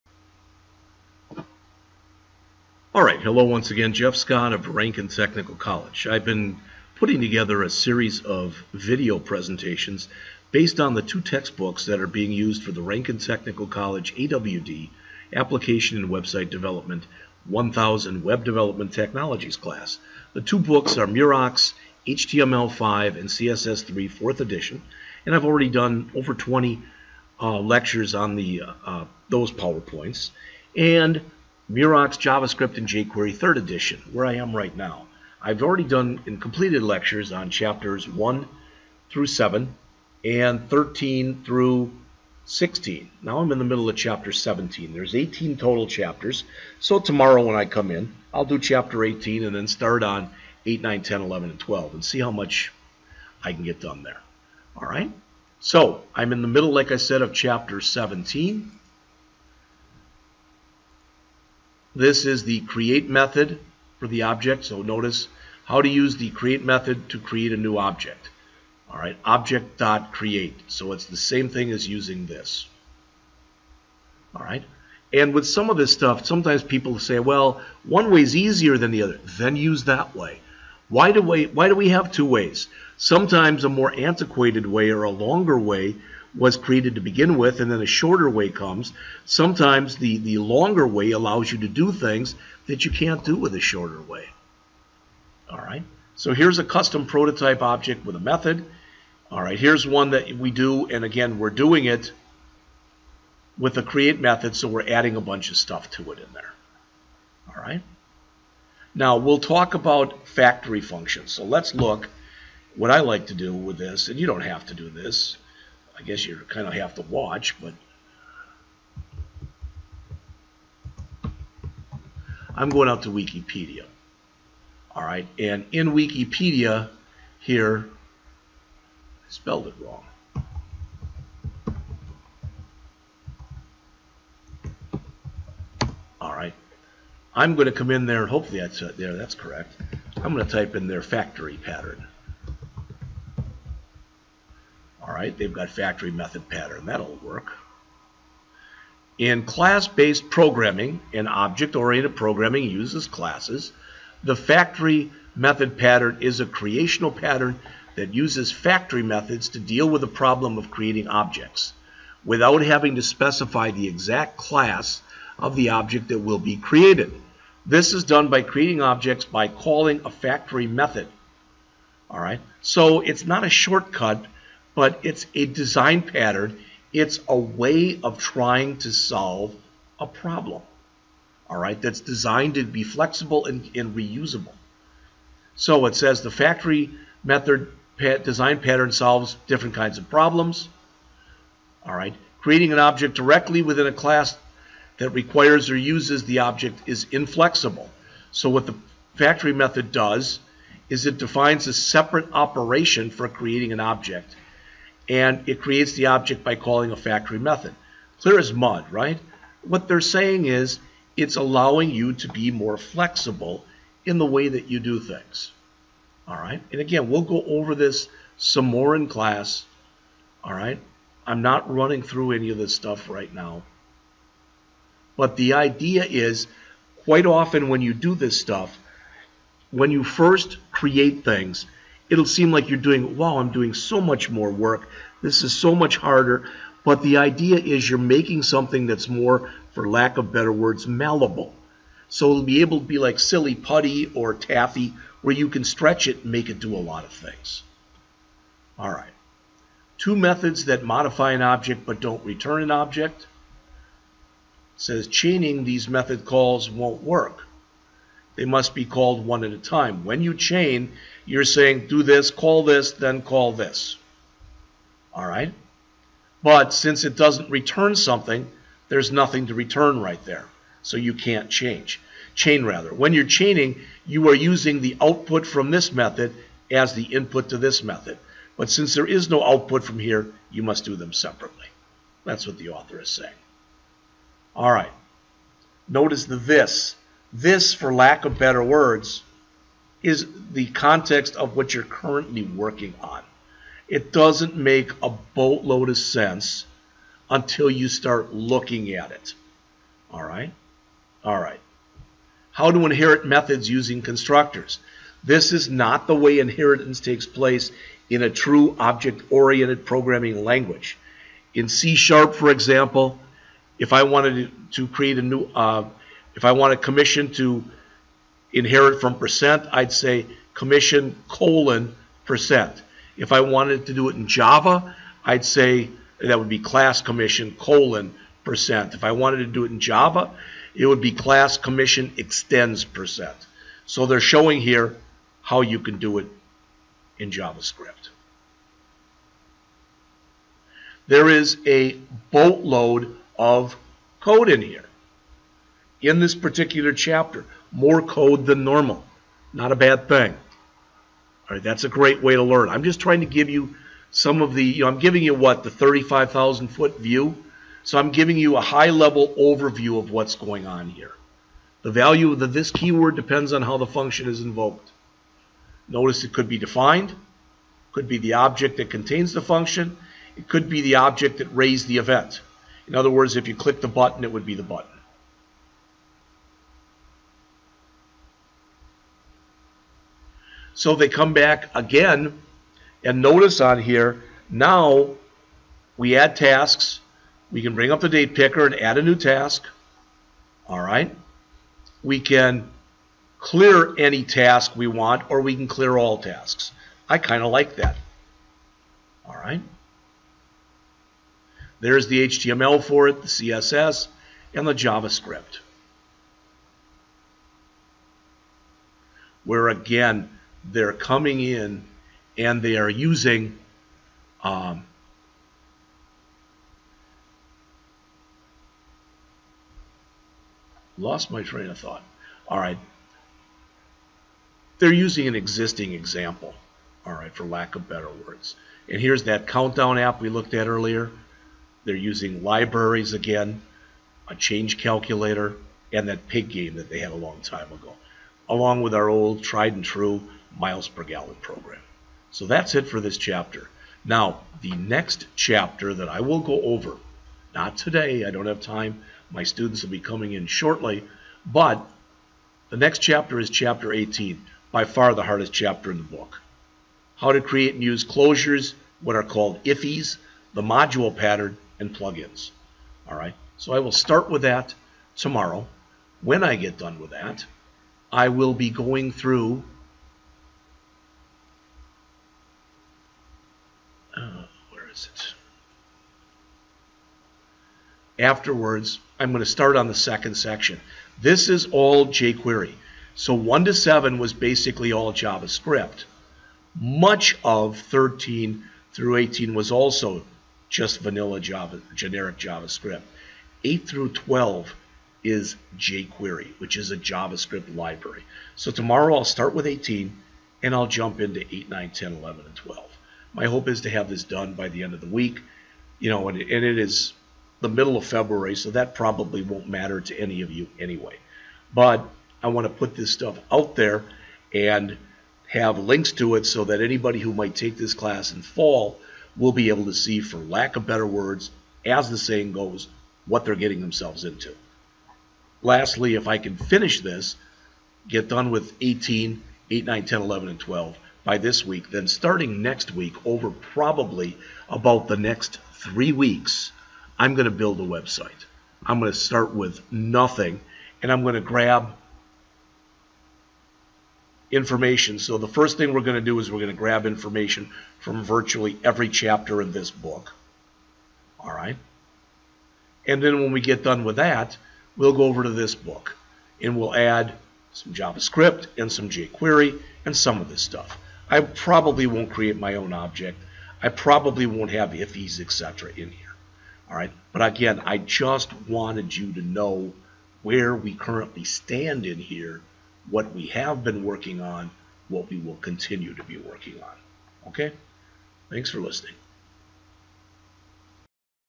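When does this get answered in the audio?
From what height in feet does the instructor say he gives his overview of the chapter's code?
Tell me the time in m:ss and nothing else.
5:55.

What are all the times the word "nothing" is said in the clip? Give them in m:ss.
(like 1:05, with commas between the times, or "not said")
4:29, 8:59.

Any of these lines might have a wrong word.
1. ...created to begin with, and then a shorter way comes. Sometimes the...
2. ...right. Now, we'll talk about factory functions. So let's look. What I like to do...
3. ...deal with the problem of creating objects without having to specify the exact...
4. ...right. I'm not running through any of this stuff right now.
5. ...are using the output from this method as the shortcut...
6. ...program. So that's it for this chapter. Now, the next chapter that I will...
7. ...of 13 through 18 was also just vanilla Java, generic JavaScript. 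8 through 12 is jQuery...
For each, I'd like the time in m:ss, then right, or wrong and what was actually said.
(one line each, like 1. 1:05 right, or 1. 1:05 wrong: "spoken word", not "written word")
1. 1:26 right
2. 1:47 right
3. 2:39 right
4. 3:40 right
5. 4:34 wrong: "input", not "shortcut"
6. 7:21 right
7. 8:07 right.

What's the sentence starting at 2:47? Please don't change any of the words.
This is done by creating objects by calling a factory method.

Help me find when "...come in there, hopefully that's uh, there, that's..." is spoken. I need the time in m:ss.
2:17.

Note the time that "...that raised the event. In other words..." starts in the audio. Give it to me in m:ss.
6:11.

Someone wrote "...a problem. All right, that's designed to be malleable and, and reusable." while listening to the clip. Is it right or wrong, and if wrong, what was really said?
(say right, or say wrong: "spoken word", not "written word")
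wrong: "flexible", not "malleable".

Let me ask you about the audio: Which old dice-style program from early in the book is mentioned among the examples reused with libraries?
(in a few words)
pig game.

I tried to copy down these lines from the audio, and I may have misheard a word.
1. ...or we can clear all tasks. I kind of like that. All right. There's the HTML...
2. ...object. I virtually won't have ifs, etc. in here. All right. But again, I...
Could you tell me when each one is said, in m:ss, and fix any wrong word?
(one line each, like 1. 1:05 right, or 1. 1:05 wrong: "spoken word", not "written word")
1. 6:35 right
2. 9:22 wrong: "probably", not "virtually".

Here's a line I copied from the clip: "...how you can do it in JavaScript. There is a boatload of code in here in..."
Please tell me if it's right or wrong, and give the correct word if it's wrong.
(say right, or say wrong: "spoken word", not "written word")
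right.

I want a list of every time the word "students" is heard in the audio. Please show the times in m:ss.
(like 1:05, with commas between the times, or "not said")
7:29.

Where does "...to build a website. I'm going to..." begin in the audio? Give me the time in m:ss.
8:57.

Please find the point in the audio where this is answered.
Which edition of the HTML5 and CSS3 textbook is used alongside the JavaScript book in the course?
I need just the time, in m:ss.
0:24.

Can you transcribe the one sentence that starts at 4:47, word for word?
This, for lack of better words, is the context of what you're currently working on.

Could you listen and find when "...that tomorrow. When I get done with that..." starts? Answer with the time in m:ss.
7:44.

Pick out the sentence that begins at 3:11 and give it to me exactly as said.
All right, creating an object directly within a class that requires or uses the object is inflexible.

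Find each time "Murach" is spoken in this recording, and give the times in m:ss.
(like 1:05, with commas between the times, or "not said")
0:21, 0:31.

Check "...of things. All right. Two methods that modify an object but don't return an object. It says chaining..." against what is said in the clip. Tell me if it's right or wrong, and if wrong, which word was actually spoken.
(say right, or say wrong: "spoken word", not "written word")
right.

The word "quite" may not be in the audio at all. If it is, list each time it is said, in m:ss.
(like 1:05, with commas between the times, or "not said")
3:47.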